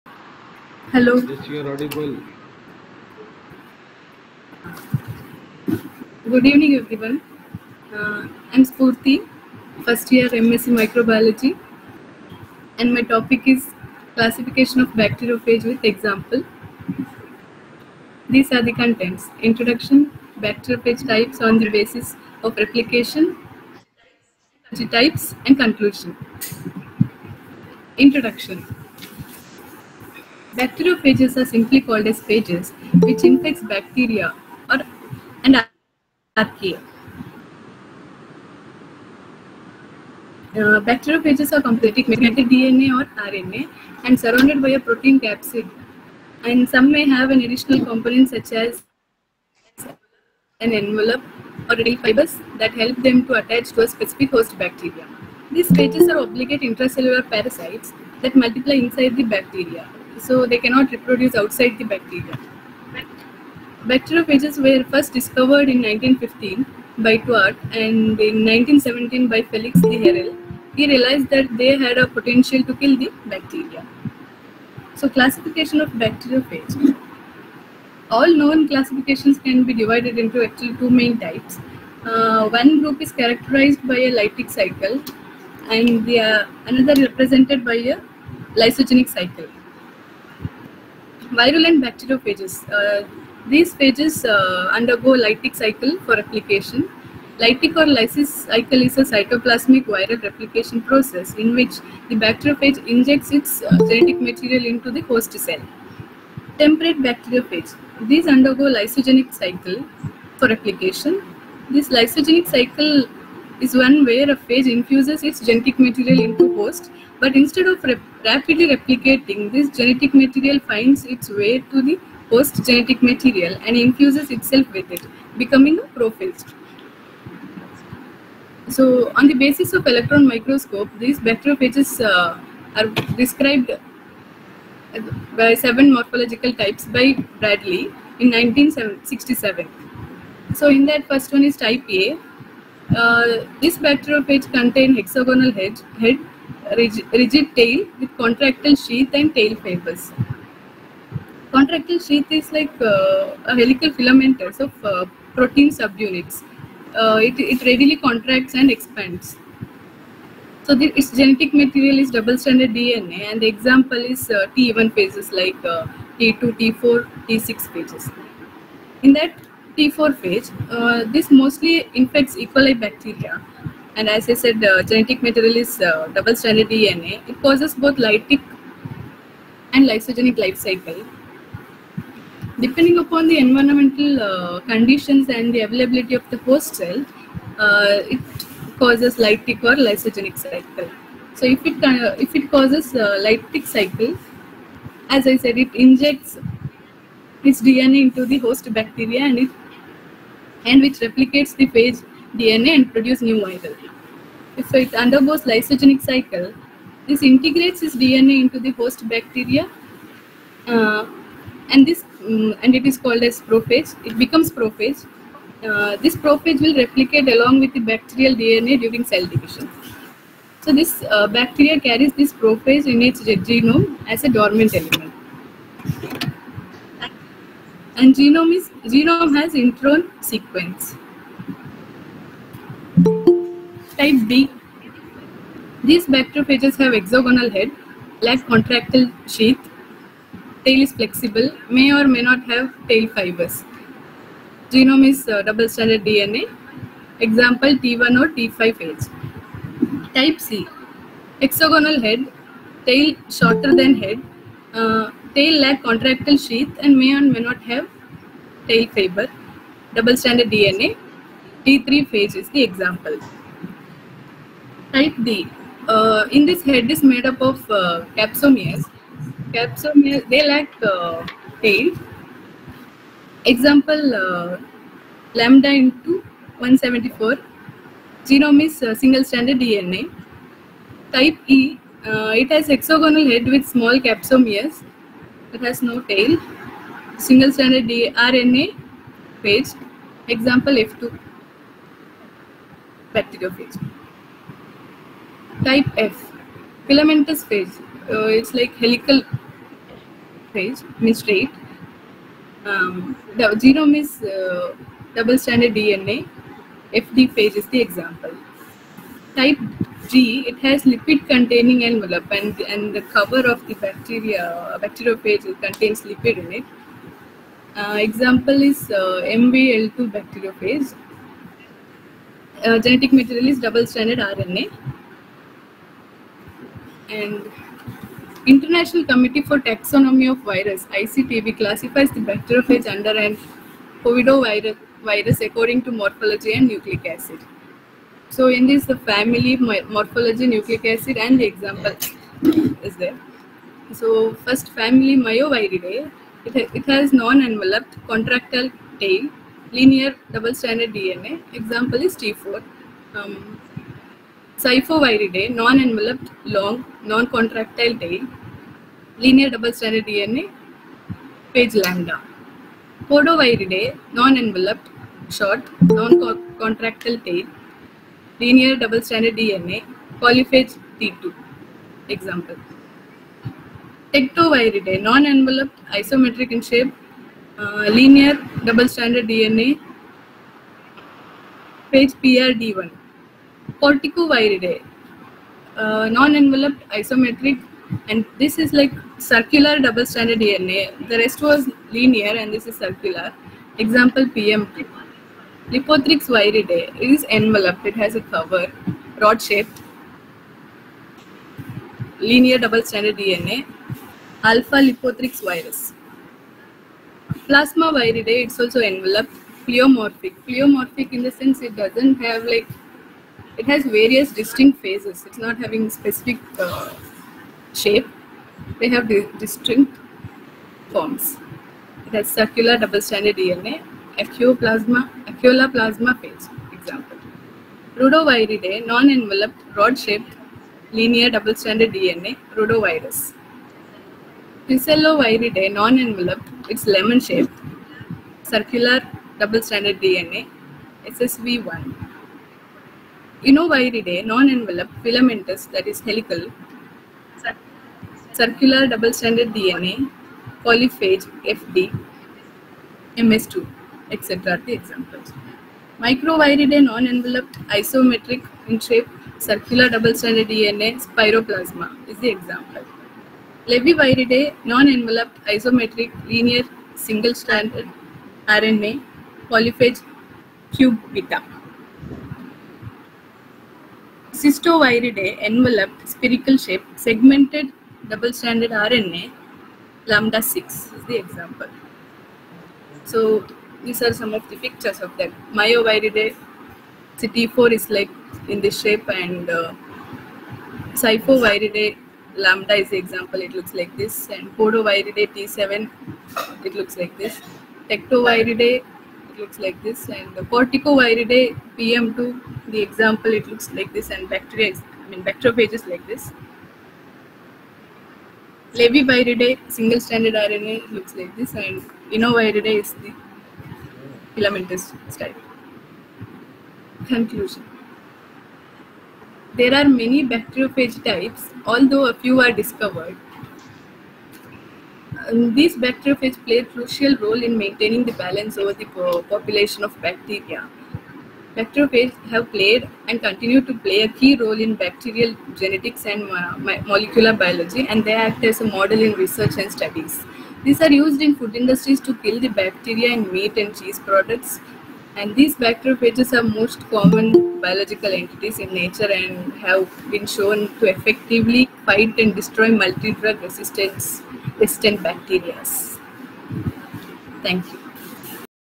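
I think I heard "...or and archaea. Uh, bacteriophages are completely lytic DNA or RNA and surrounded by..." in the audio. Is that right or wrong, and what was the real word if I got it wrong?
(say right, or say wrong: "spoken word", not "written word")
wrong: "magnetic", not "lytic".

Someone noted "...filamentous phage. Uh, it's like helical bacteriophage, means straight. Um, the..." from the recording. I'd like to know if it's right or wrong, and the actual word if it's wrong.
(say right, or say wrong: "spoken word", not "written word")
wrong: "phage", not "bacteriophage".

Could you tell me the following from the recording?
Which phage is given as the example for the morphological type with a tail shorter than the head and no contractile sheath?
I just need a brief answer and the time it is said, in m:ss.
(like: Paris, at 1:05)
T3 phage, at 4:21.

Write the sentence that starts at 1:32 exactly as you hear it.
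Uh, these phages uh, undergo lytic cycle for replication.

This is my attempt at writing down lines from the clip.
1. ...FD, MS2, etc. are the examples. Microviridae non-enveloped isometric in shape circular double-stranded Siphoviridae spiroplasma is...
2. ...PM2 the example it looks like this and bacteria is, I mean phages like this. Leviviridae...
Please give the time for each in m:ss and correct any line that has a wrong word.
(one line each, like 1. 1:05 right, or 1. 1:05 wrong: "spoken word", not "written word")
1. 7:31 wrong: "DNA", not "Siphoviridae"
2. 8:21 wrong: "bacteriophages", not "phages".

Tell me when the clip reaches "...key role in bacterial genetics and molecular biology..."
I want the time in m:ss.
8:54.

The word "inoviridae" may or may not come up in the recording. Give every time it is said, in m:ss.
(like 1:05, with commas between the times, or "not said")
7:23, 8:32.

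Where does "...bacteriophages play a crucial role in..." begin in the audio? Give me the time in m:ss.
8:45.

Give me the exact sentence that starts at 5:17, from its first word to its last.
Uh, example is uh, MBL2 bacteriophage.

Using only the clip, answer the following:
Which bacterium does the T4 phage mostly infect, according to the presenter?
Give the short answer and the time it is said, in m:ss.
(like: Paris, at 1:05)
E. coli, at 2:52.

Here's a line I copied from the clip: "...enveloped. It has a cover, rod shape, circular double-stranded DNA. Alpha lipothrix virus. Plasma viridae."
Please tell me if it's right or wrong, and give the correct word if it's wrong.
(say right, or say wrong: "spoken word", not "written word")
wrong: "linear", not "circular".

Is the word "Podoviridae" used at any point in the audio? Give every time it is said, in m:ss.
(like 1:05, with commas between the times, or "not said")
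6:03, 8:14.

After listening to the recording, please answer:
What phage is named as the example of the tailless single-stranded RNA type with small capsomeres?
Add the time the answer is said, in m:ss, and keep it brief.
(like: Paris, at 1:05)
F2, at 4:50.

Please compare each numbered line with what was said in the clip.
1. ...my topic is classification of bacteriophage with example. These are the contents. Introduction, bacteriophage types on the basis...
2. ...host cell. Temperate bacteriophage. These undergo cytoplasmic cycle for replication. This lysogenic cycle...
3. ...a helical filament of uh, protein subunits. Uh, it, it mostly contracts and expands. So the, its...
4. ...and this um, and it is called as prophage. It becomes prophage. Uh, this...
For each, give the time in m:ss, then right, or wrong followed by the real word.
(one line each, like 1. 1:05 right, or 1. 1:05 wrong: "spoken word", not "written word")
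1. 0:12 right
2. 1:45 wrong: "lysogenic", not "cytoplasmic"
3. 2:33 wrong: "readily", not "mostly"
4. 3:31 right.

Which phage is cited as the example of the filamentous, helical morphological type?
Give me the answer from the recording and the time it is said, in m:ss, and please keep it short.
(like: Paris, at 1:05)
FD phage, at 5:06.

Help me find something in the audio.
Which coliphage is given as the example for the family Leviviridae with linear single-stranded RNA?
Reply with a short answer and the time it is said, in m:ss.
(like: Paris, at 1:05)
Q beta, at 7:50.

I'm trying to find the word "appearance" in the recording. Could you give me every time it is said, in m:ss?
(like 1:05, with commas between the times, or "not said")
not said.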